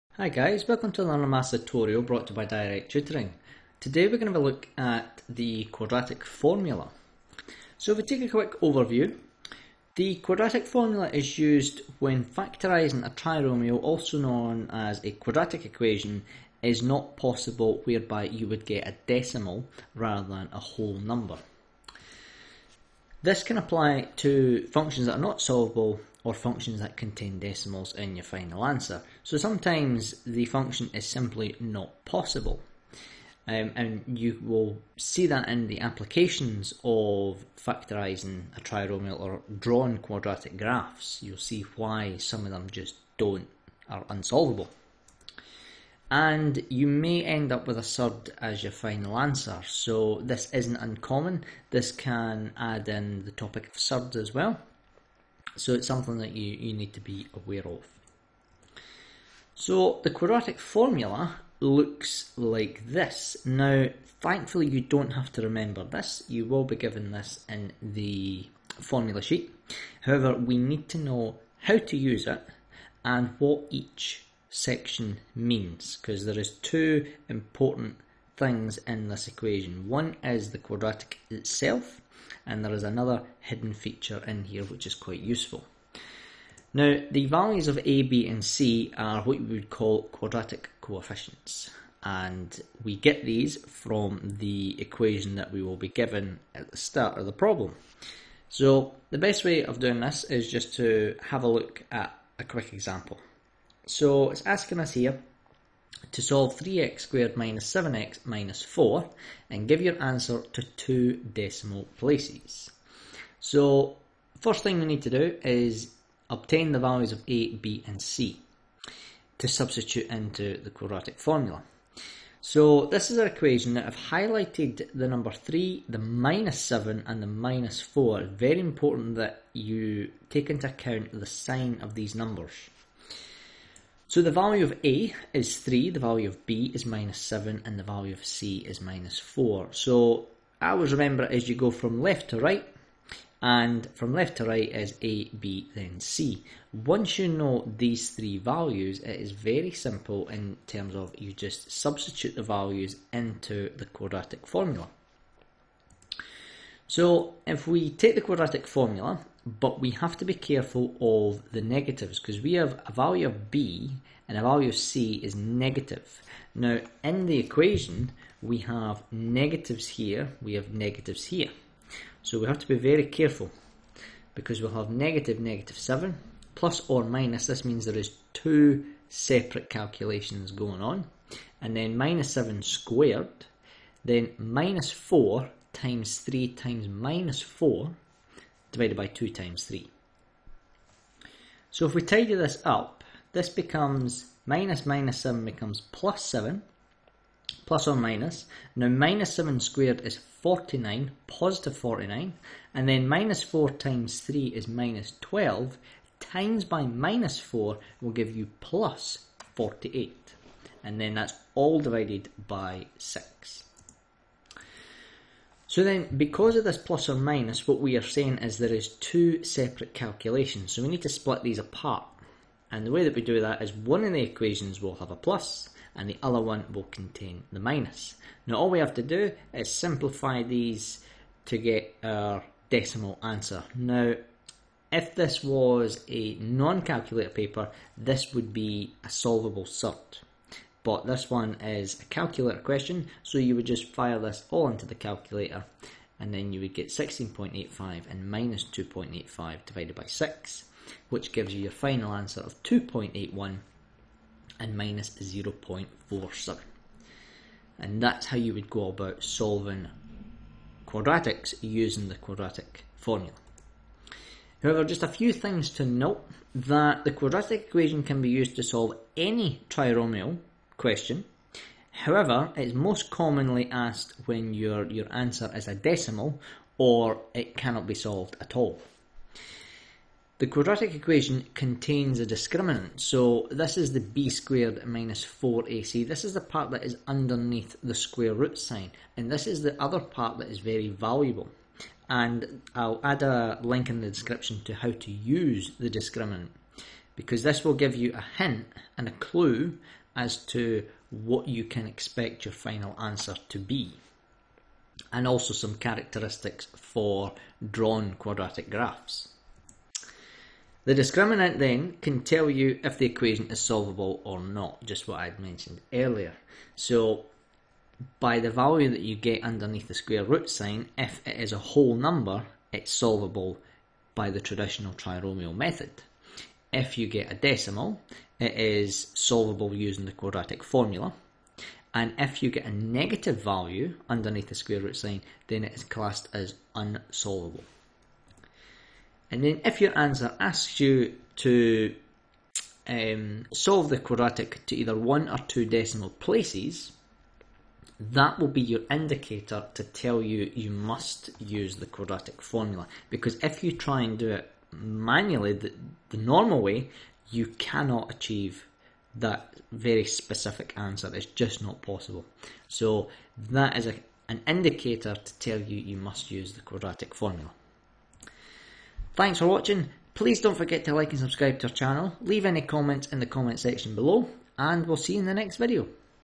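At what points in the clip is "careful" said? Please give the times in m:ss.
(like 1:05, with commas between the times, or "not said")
2:40, 2:53.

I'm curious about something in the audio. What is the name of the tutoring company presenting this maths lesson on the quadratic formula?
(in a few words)
Direct Tutoring.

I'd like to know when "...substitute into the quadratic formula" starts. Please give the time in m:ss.
1:59.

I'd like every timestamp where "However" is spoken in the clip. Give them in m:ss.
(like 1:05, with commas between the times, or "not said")
1:10, 4:24, 4:31.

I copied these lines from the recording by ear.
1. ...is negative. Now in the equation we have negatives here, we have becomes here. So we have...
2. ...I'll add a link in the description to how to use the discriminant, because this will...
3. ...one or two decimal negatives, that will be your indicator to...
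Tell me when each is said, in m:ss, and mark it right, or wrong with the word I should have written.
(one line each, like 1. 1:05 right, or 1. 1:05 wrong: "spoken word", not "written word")
1. 2:45 wrong: "negatives", not "becomes"
2. 4:52 right
3. 5:44 wrong: "places", not "negatives".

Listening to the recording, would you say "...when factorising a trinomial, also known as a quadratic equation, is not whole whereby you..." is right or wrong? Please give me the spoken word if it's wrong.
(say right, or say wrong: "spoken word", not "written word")
wrong: "possible", not "whole".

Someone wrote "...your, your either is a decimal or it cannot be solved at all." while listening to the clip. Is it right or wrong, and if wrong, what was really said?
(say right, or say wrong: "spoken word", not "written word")
wrong: "answer", not "either".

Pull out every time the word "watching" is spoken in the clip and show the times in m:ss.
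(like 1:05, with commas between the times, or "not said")
6:09.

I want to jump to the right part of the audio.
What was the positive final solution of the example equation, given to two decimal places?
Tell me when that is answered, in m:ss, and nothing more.
4:12.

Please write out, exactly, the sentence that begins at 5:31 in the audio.
And if you get a negative value underneath the square root sign, then it is classed as unsolvable.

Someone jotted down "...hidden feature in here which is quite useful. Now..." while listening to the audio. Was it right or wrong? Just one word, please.
right.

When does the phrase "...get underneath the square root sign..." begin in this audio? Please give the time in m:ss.
5:19.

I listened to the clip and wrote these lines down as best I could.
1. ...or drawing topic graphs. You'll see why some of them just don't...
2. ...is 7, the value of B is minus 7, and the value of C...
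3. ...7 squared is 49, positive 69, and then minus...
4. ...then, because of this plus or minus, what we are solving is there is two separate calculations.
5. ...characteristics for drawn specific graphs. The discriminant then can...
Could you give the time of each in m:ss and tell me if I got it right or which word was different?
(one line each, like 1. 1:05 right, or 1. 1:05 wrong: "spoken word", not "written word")
1. 0:39 wrong: "quadratic", not "topic"
2. 2:15 wrong: "3", not "7"
3. 3:19 wrong: "49", not "69"
4. 3:35 wrong: "saying", not "solving"
5. 5:05 wrong: "quadratic", not "specific".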